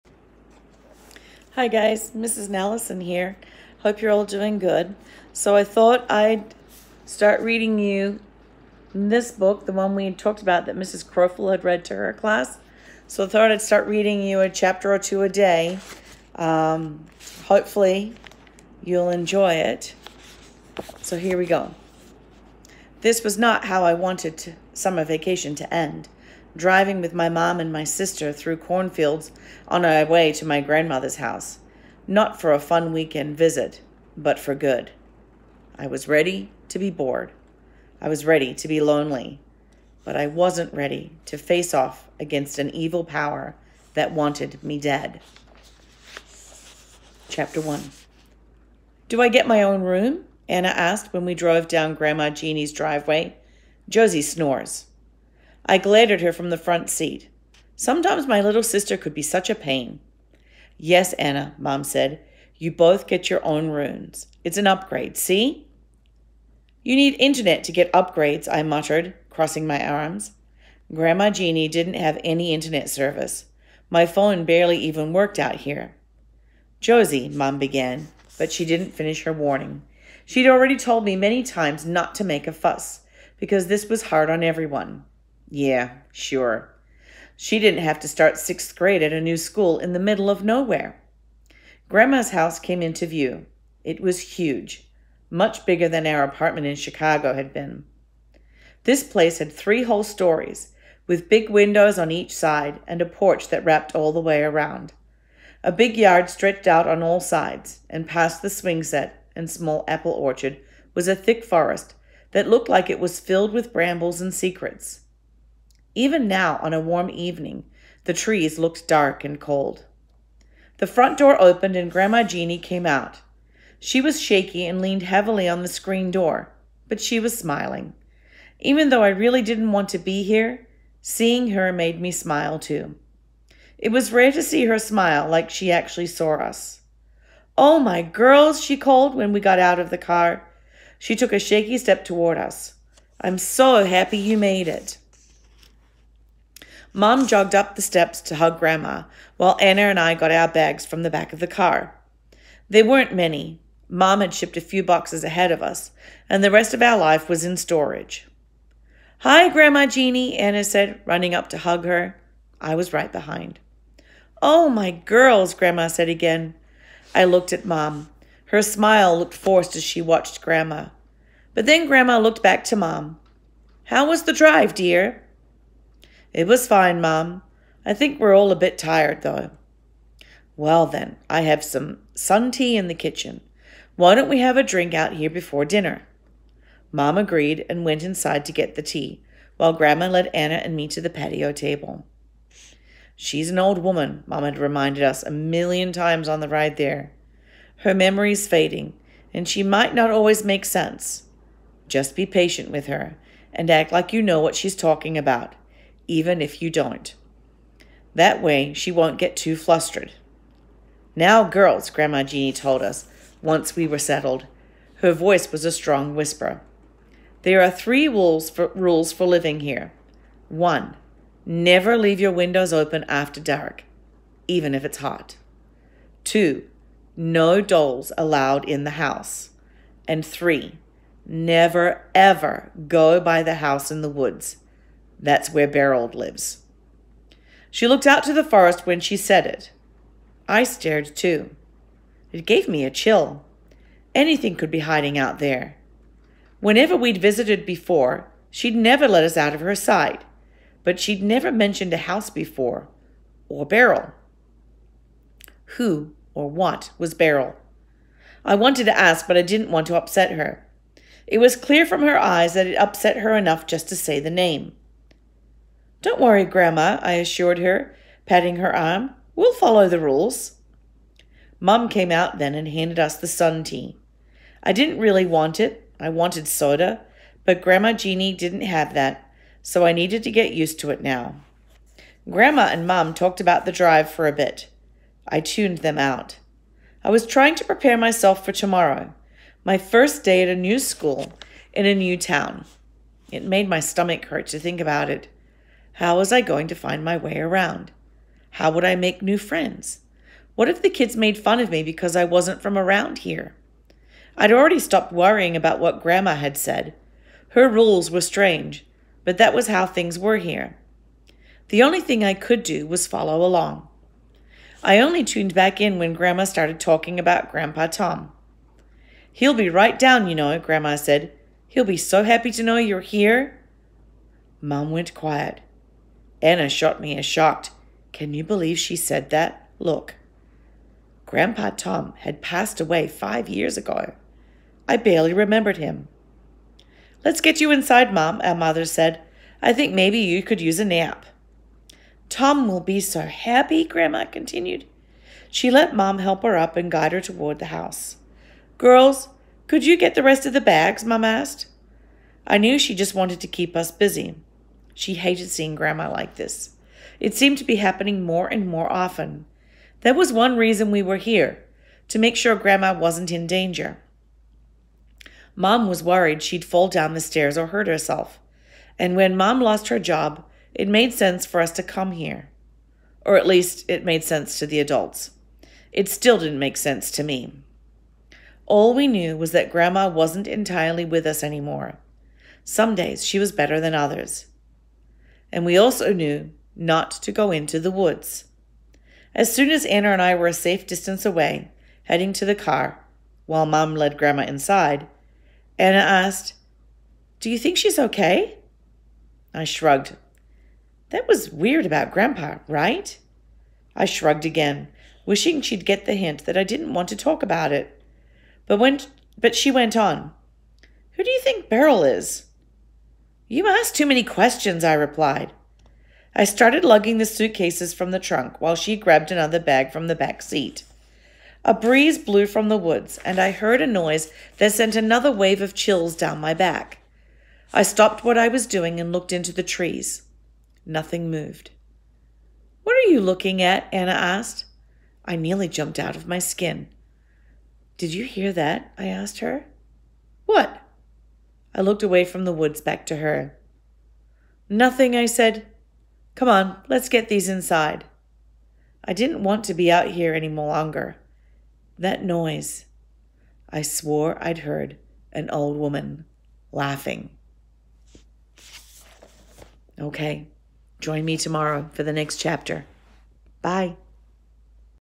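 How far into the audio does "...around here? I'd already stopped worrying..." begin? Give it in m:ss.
5:02.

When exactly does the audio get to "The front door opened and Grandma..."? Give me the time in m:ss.
2:00.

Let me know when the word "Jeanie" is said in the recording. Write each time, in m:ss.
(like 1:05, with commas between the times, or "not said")
0:52, 1:11, 2:02, 2:39, 3:32, 4:37.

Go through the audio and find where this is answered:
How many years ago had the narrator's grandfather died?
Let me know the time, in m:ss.
5:33.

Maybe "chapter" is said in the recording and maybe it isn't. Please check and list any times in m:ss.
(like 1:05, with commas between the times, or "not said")
0:14, 0:47, 7:42.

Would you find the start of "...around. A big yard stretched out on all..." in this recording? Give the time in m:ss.
1:44.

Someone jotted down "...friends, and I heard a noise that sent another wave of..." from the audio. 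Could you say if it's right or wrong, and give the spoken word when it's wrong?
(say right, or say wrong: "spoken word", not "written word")
wrong: "woods", not "friends".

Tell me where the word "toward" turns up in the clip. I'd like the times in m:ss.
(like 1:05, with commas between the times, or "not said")
2:22, 5:47.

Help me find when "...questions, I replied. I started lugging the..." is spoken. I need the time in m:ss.
6:54.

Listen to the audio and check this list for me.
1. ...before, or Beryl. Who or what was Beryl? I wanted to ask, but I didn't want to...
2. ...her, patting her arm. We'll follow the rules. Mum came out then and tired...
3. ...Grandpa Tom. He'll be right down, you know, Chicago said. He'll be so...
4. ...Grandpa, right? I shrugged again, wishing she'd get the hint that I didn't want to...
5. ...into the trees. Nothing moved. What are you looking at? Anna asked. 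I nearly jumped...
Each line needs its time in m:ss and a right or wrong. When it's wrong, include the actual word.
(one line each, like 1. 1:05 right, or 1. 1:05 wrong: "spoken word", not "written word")
1. 4:12 right
2. 4:27 wrong: "handed", not "tired"
3. 5:17 wrong: "Grandma", not "Chicago"
4. 6:42 right
5. 7:09 right.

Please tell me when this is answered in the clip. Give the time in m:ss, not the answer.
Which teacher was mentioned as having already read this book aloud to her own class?
0:10.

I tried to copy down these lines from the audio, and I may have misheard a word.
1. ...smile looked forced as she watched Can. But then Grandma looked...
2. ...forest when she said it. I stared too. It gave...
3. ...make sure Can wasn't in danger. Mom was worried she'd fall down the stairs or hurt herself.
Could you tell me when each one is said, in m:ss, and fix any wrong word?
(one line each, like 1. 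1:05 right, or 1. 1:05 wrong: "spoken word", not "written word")
1. 2:48 wrong: "Grandma", not "Can"
2. 3:58 right
3. 6:02 wrong: "Grandma", not "Can".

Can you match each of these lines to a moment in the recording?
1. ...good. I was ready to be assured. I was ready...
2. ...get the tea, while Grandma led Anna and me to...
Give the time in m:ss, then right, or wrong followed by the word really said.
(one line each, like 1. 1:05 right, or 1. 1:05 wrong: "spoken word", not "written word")
1. 0:34 wrong: "bored", not "assured"
2. 3:08 right.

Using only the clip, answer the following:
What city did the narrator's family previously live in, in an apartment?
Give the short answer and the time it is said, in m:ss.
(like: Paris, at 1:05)
Chicago, at 1:36.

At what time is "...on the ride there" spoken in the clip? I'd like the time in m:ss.
3:16.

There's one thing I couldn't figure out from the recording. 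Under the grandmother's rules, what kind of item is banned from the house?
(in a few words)
Dolls.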